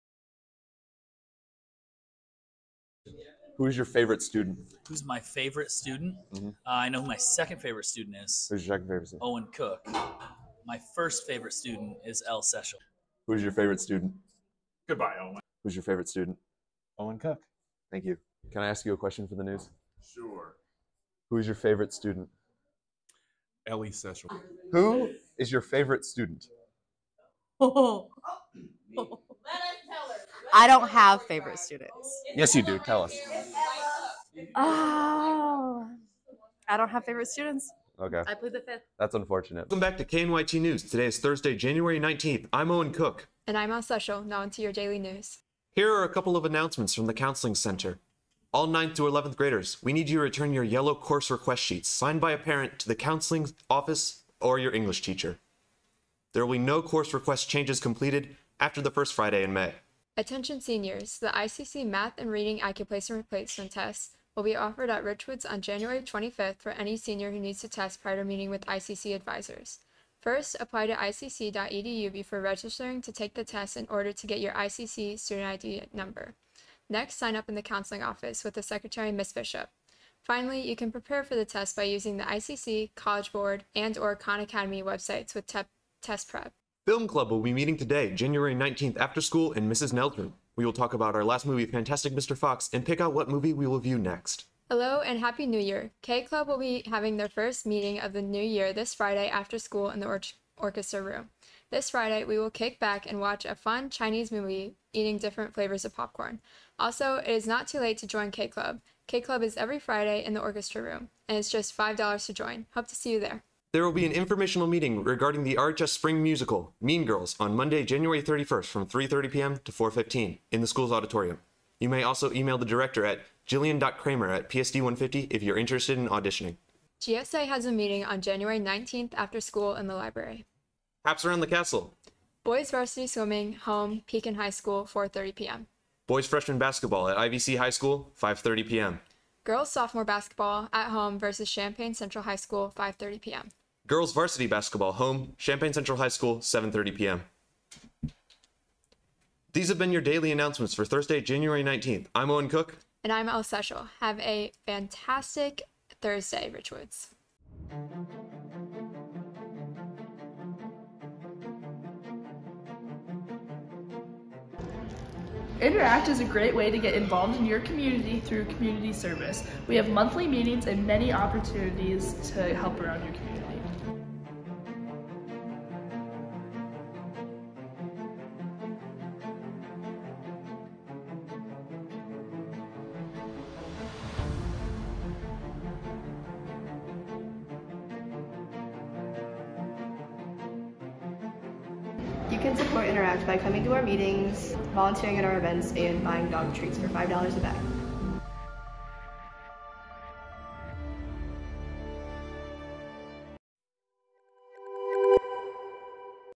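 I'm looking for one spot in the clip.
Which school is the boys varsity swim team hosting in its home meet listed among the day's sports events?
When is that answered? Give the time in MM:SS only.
02:14.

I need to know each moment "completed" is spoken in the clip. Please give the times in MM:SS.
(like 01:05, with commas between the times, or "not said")
00:57.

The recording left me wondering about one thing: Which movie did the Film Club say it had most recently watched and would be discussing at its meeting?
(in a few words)
Fantastic Mr. Fox.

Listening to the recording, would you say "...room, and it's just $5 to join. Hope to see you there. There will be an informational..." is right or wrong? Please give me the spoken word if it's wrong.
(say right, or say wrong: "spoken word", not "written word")
right.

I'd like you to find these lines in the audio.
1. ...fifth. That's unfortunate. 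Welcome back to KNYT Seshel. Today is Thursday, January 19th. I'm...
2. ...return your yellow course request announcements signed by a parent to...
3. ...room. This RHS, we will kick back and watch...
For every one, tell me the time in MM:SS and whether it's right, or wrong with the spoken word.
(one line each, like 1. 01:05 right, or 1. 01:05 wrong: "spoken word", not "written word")
1. 00:38 wrong: "News", not "Seshel"
2. 00:50 wrong: "sheets", not "announcements"
3. 01:41 wrong: "Friday", not "RHS".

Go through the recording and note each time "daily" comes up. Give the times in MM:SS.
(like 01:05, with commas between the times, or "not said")
00:44, 02:30.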